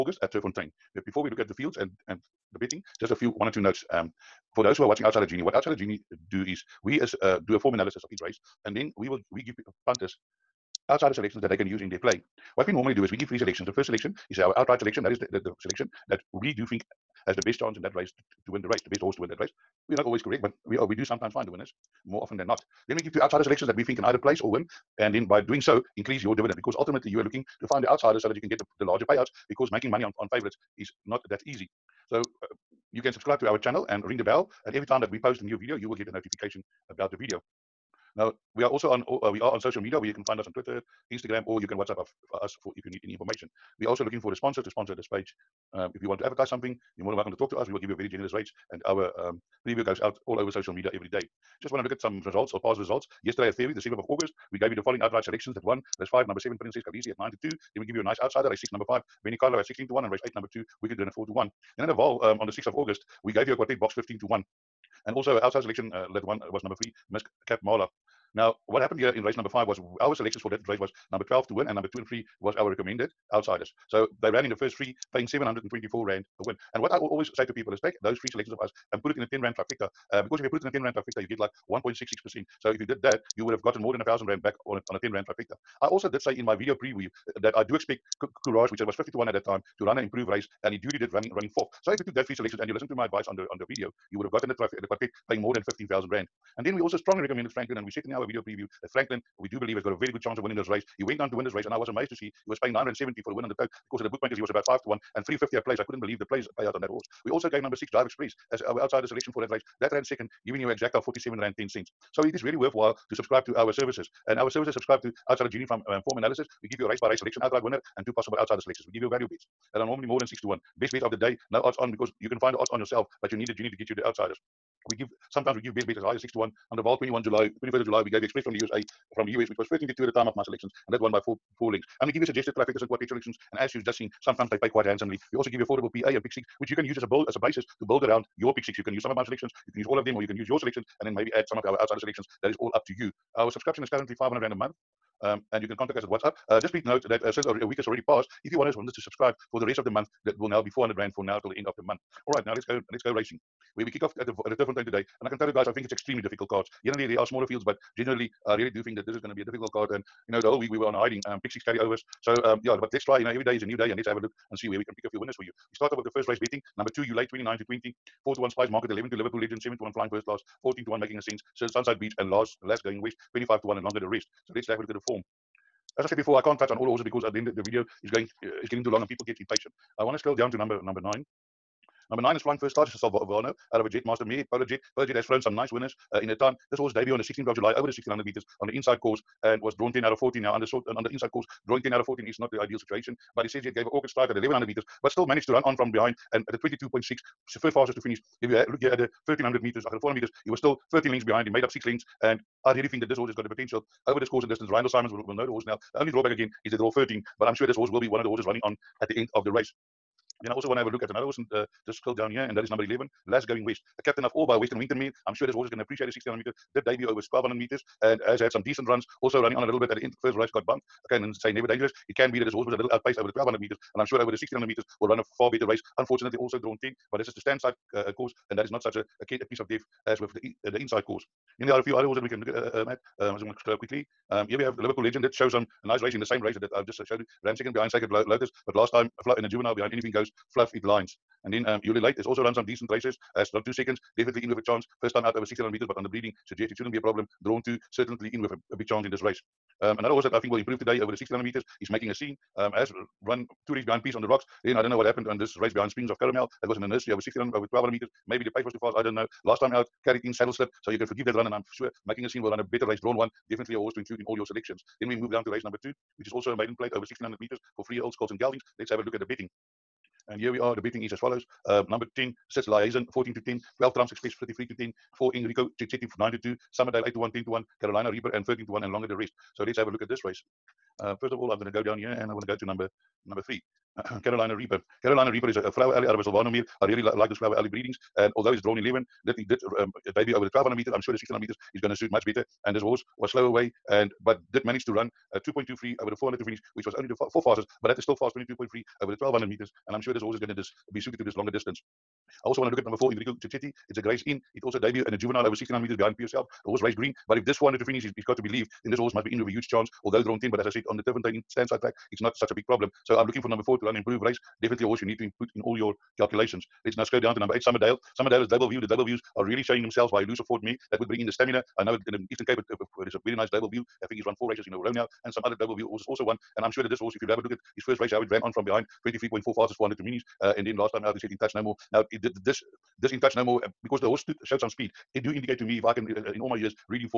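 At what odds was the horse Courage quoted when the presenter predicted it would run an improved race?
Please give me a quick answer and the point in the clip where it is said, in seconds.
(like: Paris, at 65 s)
50 to 1, at 88 s.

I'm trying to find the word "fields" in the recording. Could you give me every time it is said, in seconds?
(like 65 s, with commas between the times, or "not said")
1 s, 157 s.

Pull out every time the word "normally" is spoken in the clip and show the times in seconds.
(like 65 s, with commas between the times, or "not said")
12 s, 119 s.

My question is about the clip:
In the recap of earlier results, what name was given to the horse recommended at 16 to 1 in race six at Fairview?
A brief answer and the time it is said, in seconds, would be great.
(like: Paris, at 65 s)
Benicarlo, at 59 s.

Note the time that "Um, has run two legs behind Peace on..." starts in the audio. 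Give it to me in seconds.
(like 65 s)
252 s.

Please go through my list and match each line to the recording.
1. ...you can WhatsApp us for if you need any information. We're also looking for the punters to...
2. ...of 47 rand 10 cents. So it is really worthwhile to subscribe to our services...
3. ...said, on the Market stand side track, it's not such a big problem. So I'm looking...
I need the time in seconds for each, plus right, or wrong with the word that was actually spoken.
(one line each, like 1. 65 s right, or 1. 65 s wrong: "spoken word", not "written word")
1. 41 s wrong: "sponsors", not "punters"
2. 110 s right
3. 310 s wrong: "Turffontein", not "Market".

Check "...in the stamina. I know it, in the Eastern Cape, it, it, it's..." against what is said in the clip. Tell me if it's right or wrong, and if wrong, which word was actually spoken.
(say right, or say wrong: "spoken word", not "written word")
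right.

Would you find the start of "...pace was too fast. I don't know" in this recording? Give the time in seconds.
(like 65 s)
258 s.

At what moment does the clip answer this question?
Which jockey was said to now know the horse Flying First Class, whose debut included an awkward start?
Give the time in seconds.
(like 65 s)
204 s.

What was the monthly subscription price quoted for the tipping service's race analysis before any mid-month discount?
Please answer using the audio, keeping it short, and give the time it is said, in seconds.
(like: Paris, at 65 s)
500 rand, at 144 s.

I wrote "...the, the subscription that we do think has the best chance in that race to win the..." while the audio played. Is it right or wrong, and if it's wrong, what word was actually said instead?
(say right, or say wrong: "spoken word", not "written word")
wrong: "selection", not "subscription".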